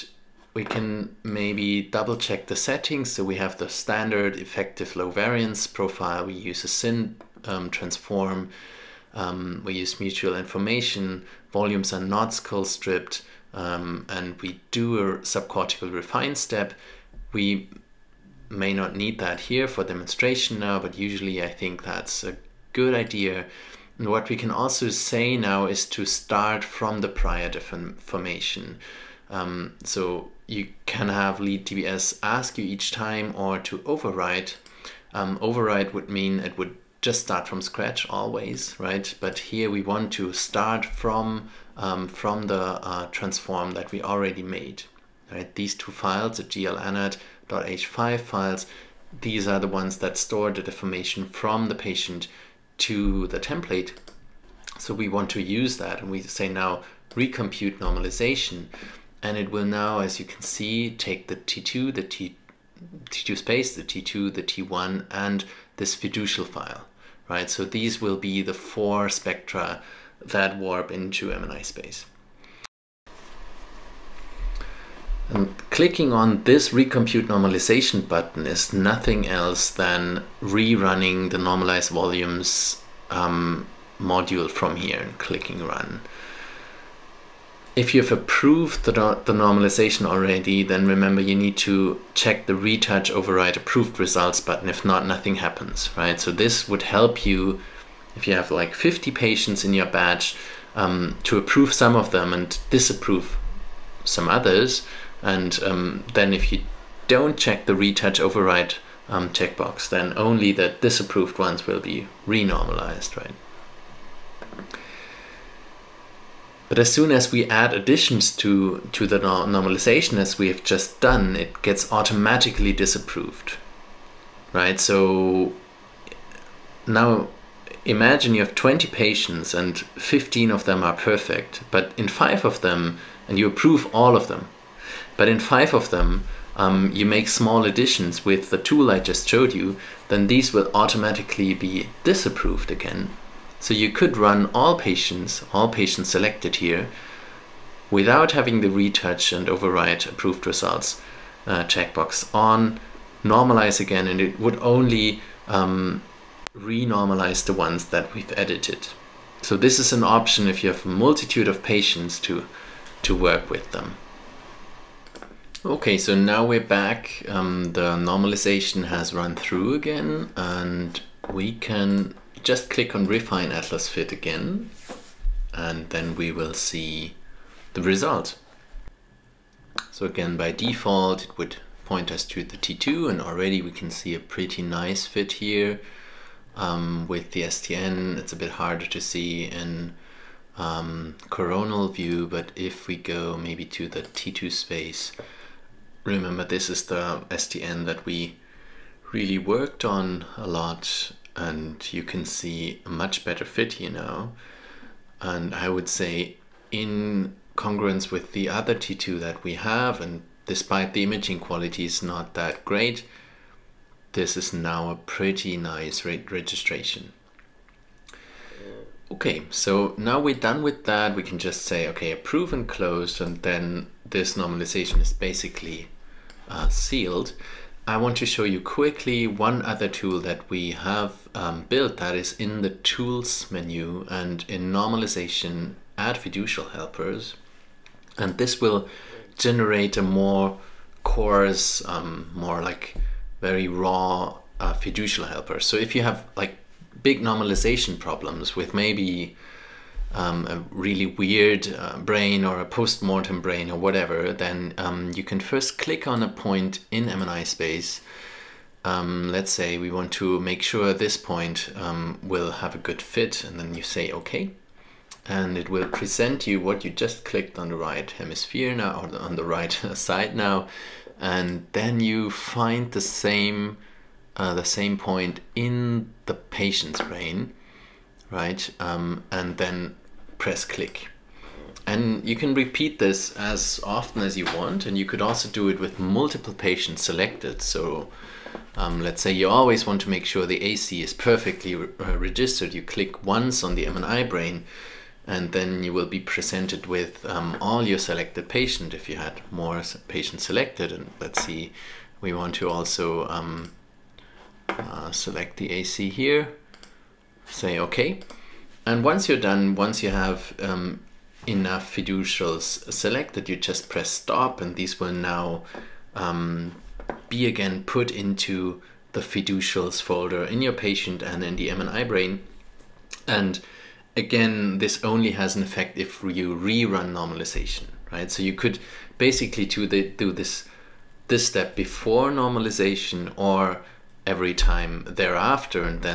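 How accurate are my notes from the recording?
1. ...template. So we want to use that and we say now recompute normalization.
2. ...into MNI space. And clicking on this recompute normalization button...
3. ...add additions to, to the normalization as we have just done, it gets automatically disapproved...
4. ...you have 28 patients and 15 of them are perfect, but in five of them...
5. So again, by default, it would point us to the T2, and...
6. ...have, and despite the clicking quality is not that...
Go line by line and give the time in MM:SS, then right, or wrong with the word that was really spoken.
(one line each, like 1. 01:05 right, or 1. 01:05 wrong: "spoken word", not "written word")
1. 00:53 right
2. 01:10 right
3. 01:57 right
4. 02:08 wrong: "20", not "28"
5. 02:59 right
6. 03:29 wrong: "imaging", not "clicking".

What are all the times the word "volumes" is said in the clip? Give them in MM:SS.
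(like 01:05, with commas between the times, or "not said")
00:11, 01:21.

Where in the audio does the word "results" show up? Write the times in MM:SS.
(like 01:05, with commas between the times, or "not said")
01:33, 02:30, 02:57.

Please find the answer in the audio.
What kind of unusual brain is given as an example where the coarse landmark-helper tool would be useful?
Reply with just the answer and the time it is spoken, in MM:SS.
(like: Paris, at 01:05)
A post-mortem brain, at 04:12.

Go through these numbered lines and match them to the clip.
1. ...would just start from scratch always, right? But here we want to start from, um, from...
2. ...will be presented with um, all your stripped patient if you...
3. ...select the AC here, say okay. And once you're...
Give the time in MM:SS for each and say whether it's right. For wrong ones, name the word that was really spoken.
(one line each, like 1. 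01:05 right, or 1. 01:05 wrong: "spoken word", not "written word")
1. 00:36 right
2. 04:55 wrong: "selected", not "stripped"
3. 05:05 right.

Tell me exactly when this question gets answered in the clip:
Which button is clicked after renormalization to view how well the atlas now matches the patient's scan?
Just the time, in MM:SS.
02:53.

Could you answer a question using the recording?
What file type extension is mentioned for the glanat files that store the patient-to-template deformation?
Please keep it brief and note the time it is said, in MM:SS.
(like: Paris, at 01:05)
.h5, at 00:46.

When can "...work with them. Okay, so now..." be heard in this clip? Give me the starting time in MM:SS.
02:43.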